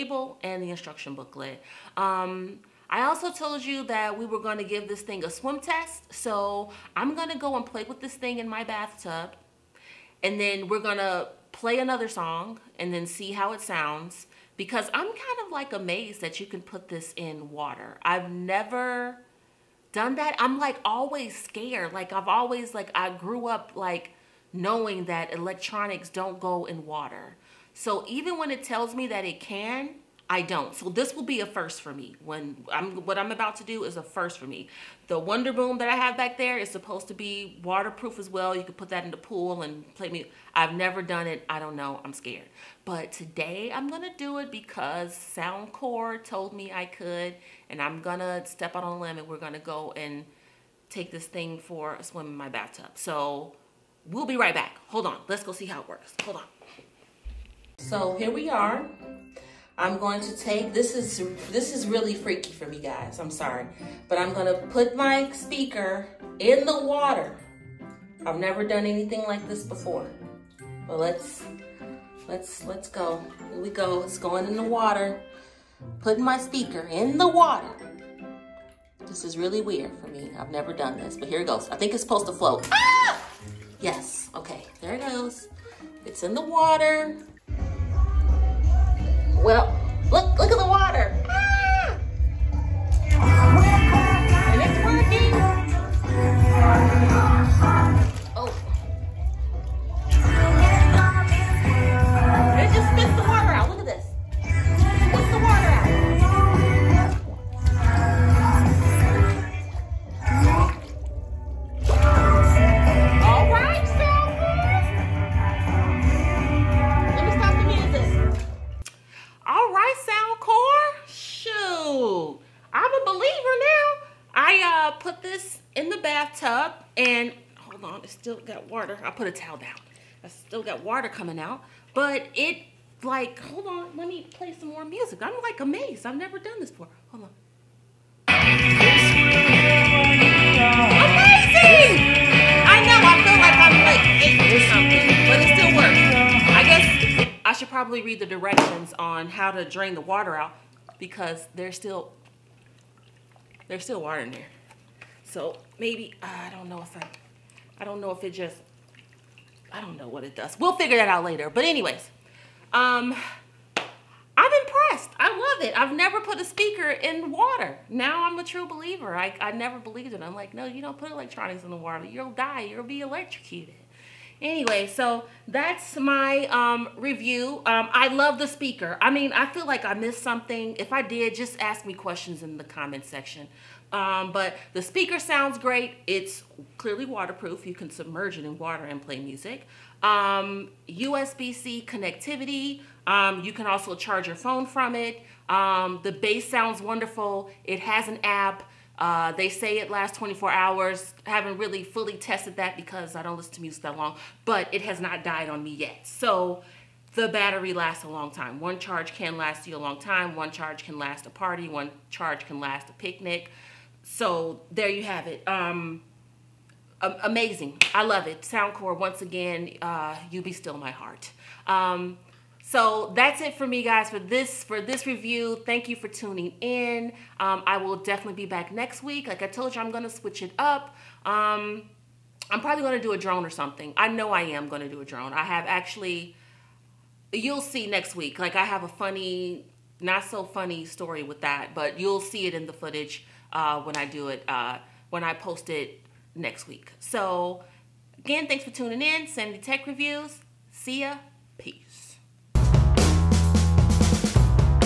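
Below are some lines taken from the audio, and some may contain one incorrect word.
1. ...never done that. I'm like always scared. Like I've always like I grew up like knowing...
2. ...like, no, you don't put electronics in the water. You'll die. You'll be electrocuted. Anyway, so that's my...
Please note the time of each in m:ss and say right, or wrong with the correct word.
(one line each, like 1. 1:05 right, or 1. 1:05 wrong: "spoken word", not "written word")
1. 0:18 right
2. 2:50 right.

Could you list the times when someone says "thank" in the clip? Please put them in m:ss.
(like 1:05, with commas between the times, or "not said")
3:45, 4:08.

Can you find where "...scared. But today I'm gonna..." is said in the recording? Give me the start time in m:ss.
0:42.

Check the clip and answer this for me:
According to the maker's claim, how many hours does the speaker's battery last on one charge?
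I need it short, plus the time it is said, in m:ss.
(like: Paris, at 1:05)
24, at 3:20.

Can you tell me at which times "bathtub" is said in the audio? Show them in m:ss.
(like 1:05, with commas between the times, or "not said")
0:08, 0:52, 2:05.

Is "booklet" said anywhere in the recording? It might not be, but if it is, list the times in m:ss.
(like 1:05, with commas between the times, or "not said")
0:01.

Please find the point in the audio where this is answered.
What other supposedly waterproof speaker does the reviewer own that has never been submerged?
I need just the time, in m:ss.
0:35.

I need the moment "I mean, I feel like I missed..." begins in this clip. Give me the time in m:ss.
2:59.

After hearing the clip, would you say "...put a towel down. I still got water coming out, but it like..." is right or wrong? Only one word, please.
right.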